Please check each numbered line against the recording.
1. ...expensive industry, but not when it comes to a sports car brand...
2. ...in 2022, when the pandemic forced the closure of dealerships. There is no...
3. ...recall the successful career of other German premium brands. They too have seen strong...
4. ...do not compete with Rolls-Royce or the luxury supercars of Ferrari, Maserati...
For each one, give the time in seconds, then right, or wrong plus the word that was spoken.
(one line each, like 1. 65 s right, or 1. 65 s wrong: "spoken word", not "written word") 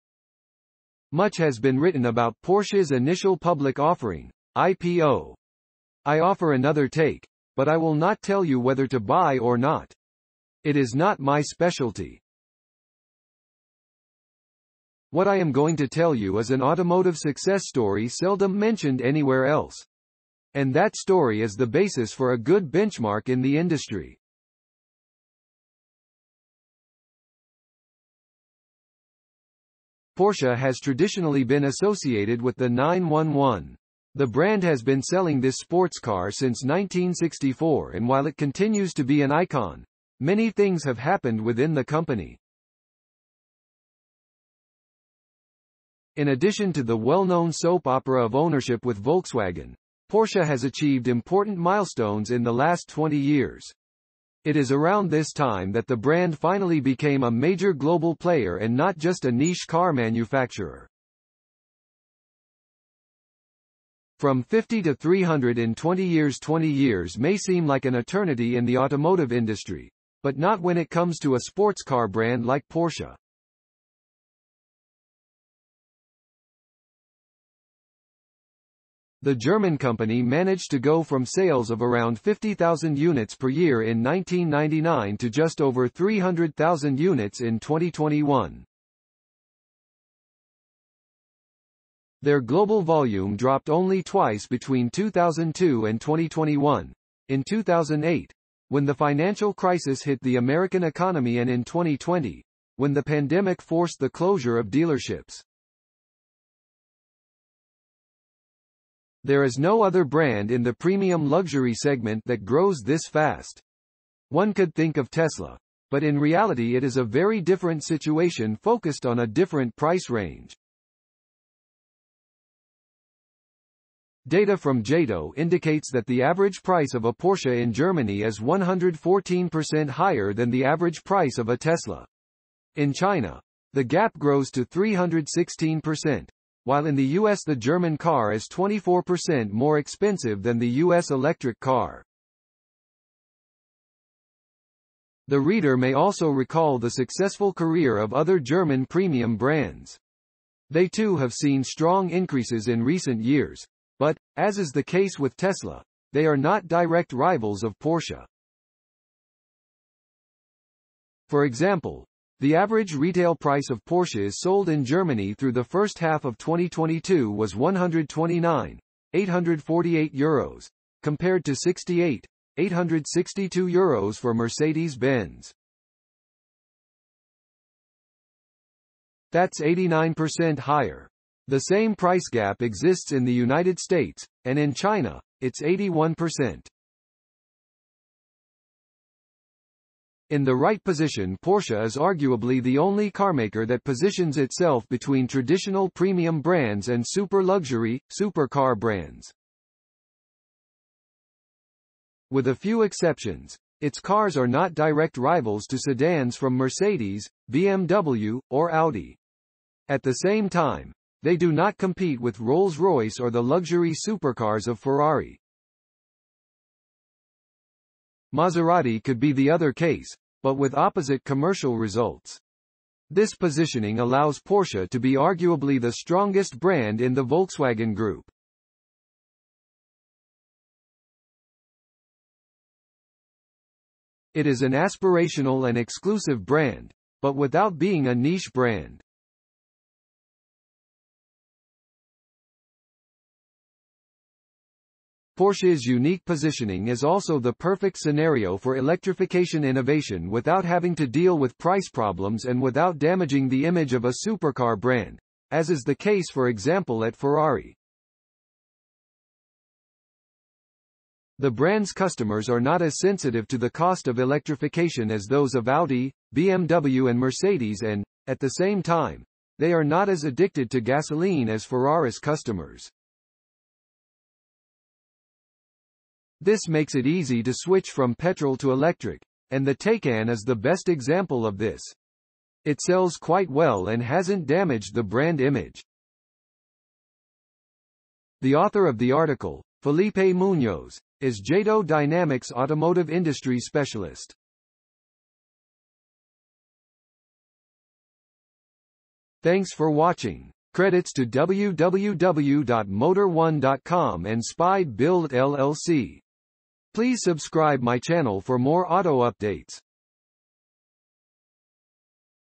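1. 68 s wrong: "automotive", not "expensive"
2. 101 s wrong: "2020", not "2022"
3. 146 s right
4. 211 s right.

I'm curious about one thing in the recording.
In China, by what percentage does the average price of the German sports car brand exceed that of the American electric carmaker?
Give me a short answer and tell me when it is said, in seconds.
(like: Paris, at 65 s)
316%, at 134 s.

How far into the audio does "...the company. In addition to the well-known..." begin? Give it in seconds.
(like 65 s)
41 s.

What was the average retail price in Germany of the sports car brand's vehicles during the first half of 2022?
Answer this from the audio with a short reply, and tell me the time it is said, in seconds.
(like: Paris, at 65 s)
129,848 euros, at 167 s.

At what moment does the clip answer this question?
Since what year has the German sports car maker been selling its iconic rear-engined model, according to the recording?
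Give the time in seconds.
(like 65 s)
36 s.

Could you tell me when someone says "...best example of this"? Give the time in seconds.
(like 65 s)
280 s.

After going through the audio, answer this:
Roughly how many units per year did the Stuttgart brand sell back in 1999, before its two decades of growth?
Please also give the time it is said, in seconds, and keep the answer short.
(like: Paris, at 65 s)
50,000, at 82 s.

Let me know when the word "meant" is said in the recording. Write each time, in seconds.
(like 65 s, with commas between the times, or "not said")
not said.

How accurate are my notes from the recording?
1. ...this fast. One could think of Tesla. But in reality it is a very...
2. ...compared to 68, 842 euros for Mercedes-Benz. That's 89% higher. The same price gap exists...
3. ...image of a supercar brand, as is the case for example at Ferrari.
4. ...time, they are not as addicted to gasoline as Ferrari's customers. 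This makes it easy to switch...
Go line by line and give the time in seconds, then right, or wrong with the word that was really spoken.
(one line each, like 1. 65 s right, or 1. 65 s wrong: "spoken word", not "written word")
1. 112 s right
2. 171 s wrong: "862", not "842"
3. 253 s right
4. 268 s right.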